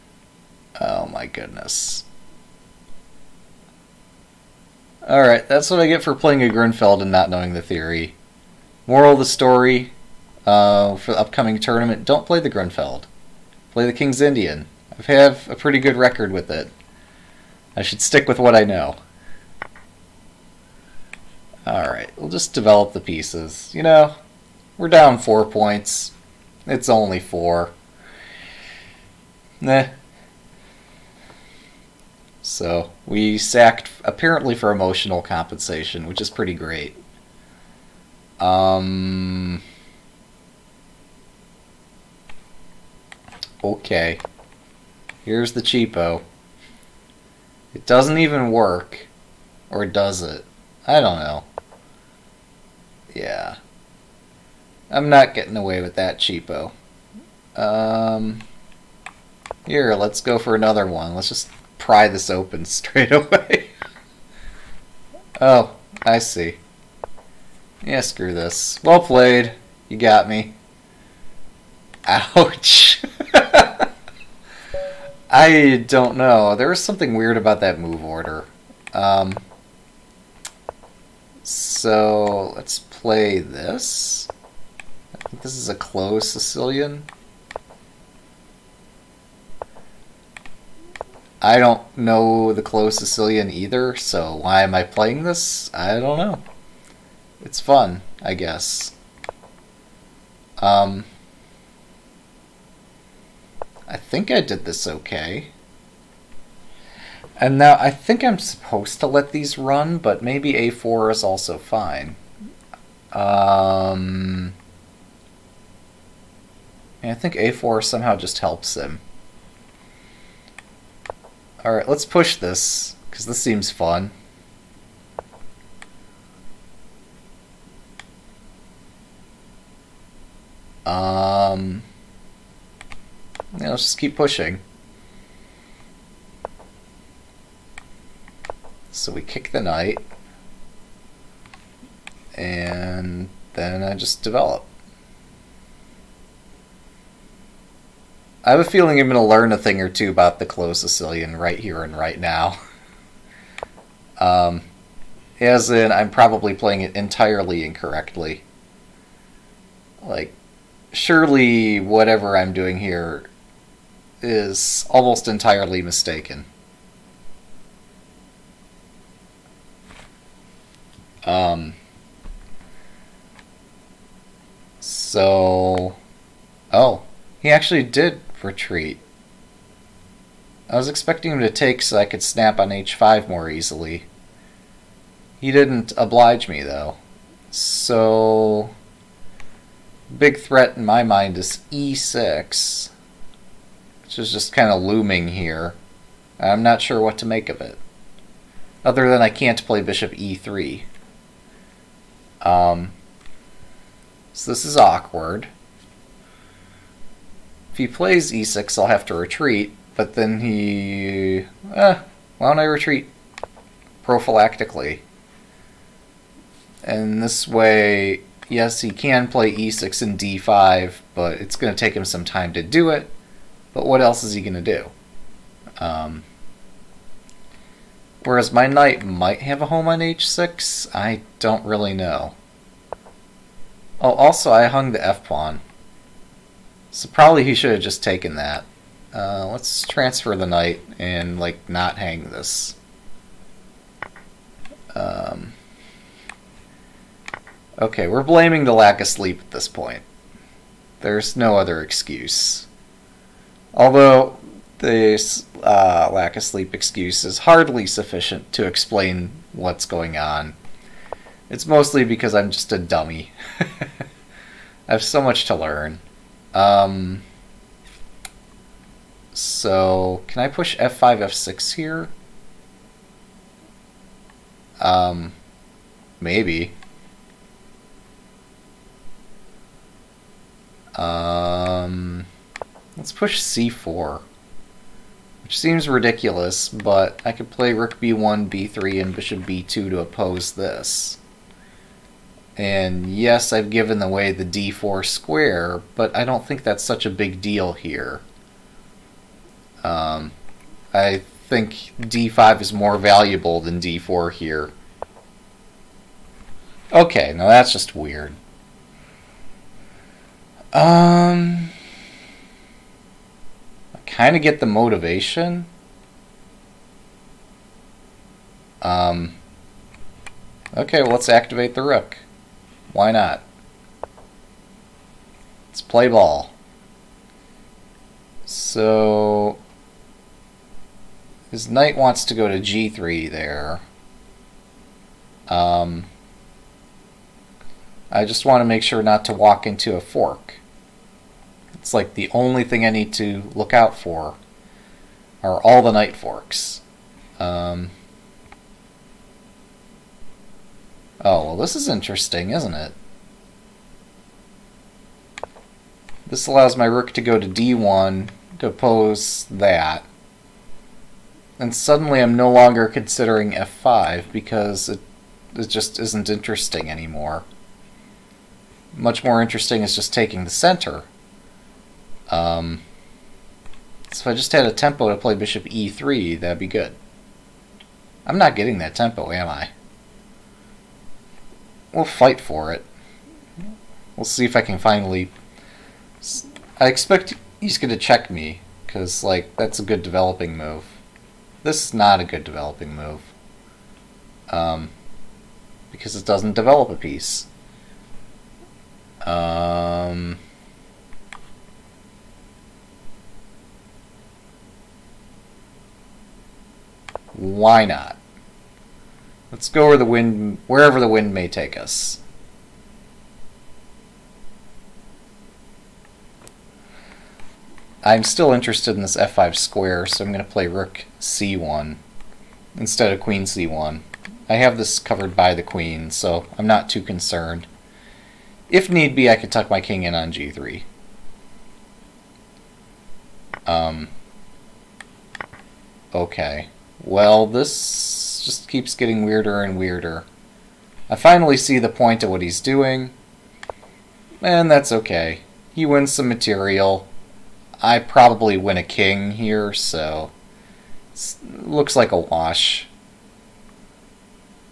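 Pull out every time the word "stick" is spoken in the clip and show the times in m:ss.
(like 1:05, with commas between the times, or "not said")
0:18.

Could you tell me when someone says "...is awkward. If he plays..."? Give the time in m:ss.
3:24.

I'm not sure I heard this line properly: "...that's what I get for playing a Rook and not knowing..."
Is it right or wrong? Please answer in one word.
wrong.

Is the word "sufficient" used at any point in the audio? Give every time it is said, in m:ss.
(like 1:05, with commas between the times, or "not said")
4:17.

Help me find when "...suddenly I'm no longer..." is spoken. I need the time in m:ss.
6:01.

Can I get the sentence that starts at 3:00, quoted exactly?
I was expecting him to take so I could snap on h5 more easily.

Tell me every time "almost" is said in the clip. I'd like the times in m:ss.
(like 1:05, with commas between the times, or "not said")
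2:44.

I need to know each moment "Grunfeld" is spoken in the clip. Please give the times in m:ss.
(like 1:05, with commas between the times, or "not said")
0:06, 0:12.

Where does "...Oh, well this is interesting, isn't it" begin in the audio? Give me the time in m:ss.
5:51.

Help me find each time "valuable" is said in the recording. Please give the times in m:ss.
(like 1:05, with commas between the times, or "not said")
5:02.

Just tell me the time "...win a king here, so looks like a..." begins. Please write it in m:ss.
7:28.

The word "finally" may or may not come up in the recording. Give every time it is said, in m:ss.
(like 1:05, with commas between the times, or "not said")
6:24, 7:21.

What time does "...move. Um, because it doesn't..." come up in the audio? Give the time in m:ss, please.
6:32.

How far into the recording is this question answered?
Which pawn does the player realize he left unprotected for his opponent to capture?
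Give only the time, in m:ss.
3:55.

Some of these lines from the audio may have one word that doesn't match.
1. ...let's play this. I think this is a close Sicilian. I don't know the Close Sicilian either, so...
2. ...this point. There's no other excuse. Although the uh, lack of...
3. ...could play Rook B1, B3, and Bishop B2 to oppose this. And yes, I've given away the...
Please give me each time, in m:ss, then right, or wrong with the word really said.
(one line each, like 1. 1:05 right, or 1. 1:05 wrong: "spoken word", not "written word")
1. 1:22 right
2. 4:09 right
3. 4:47 right.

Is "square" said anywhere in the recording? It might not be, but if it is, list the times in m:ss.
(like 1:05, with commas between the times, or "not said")
4:55, 6:59.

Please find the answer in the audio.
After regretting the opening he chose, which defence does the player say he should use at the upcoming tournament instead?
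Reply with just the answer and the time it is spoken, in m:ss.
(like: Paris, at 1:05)
King's Indian, at 0:13.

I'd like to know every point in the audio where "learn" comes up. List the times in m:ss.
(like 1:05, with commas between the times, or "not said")
2:29, 4:25.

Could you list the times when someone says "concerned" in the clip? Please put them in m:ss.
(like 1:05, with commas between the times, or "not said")
7:07.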